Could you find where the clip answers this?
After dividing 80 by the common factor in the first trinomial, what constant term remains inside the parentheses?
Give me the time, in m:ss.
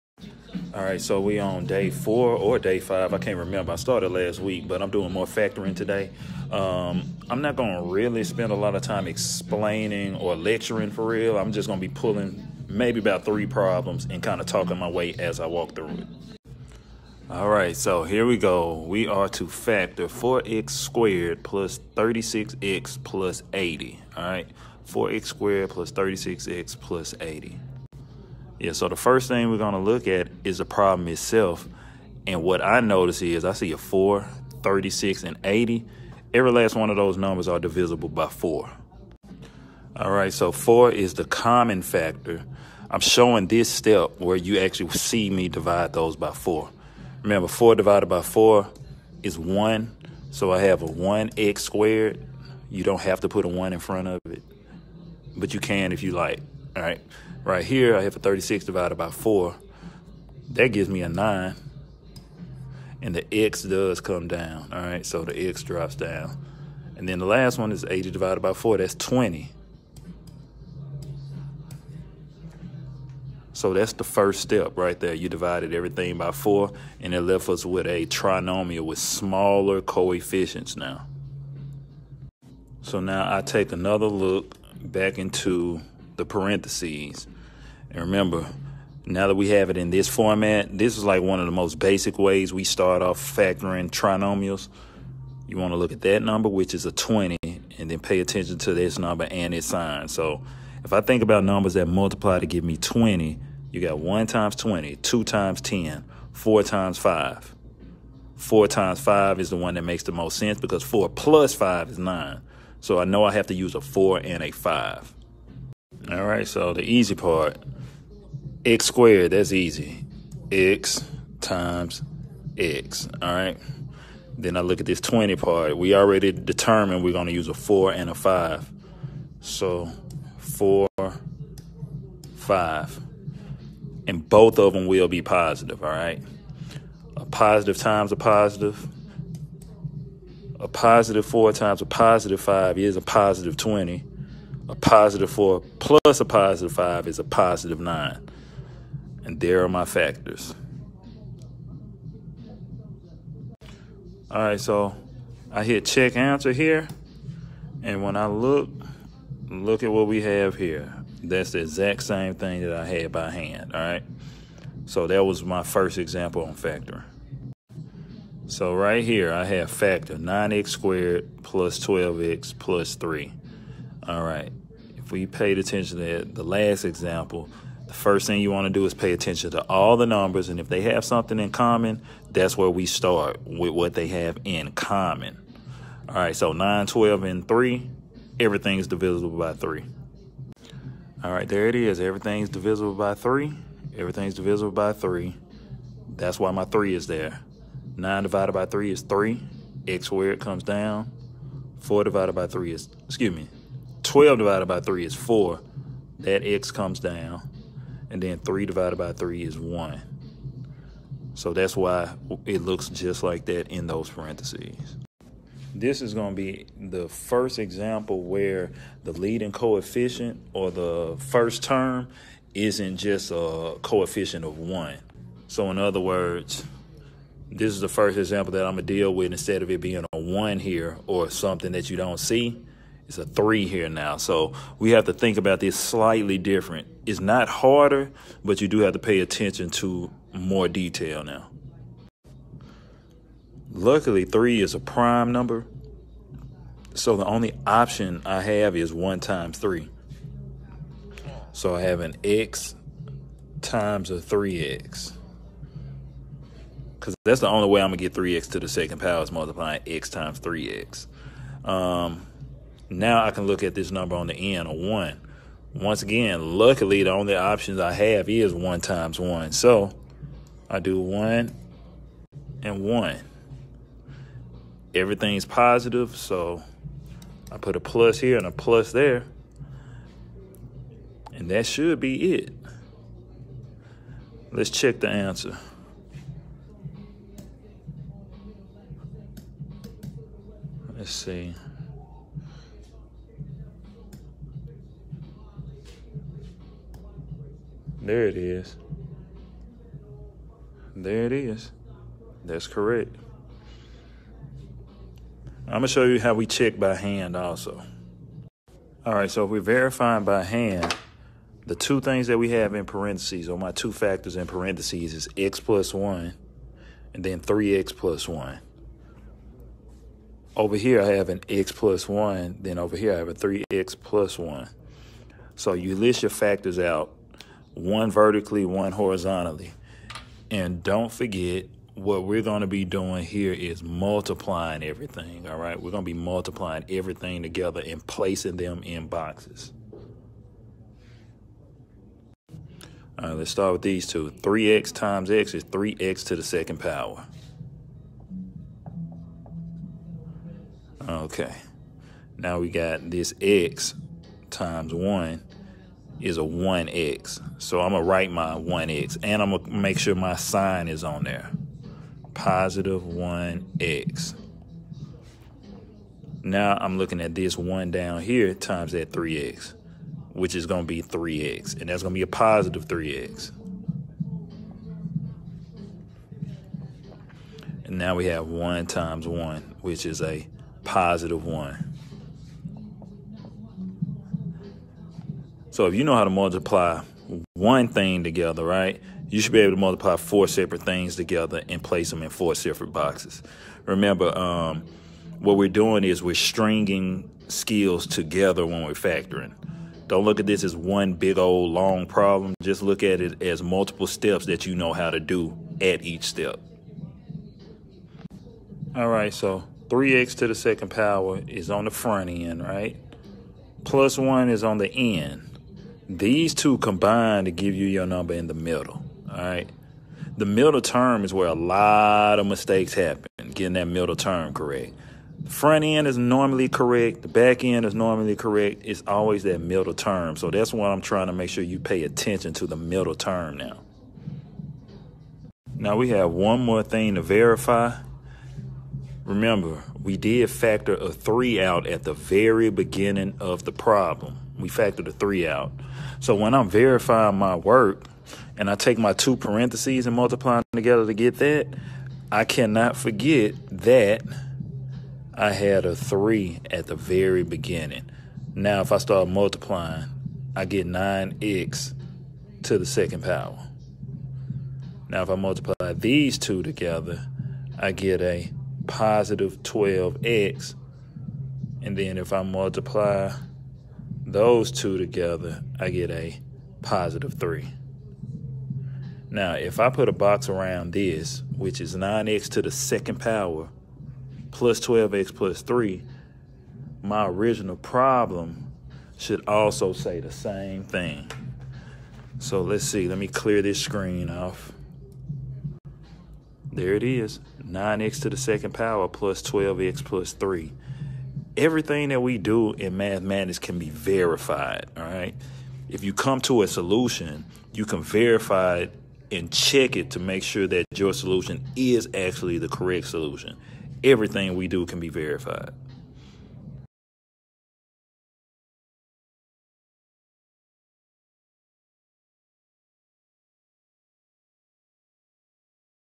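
1:08.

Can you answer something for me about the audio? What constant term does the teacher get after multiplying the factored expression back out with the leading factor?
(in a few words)
3.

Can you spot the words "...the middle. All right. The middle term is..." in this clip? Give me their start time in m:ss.
6:58.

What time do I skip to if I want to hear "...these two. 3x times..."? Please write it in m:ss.
5:43.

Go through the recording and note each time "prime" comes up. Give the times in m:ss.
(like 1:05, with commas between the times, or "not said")
4:04.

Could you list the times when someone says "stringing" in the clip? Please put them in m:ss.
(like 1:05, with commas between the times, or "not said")
6:36.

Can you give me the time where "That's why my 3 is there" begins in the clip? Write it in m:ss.
3:16.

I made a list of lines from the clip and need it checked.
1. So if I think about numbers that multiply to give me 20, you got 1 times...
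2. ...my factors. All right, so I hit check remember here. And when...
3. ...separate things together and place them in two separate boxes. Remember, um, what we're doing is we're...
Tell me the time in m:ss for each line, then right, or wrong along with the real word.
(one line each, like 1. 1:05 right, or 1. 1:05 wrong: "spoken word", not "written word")
1. 1:40 right
2. 2:29 wrong: "answer", not "remember"
3. 6:30 wrong: "four", not "two".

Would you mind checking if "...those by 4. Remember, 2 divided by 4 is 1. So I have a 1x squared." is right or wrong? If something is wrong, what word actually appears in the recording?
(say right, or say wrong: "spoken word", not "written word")
wrong: "4", not "2".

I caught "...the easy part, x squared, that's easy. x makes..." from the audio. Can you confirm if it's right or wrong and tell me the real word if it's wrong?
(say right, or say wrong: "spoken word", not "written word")
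wrong: "times", not "makes".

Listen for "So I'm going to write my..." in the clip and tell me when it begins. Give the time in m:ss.
5:57.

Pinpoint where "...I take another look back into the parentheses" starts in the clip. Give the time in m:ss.
1:23.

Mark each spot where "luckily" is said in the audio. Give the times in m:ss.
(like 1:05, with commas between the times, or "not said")
4:03, 4:26.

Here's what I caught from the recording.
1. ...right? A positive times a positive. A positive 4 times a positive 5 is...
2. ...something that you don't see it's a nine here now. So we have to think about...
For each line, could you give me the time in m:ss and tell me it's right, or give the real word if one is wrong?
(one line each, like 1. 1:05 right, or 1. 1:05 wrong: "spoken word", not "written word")
1. 2:15 right
2. 3:51 wrong: "three", not "nine".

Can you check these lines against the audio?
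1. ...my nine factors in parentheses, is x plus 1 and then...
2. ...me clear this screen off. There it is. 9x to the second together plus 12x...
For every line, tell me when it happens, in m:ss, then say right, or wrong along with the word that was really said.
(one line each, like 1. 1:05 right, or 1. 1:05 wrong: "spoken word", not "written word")
1. 5:13 wrong: "two", not "nine"
2. 8:13 wrong: "power", not "together".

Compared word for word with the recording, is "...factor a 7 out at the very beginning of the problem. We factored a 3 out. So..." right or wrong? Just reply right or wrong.
wrong.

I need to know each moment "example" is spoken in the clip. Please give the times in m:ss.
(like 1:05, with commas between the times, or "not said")
2:45, 2:56, 3:37, 3:48.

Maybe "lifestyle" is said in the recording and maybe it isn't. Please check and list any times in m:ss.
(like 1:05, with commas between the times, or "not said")
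not said.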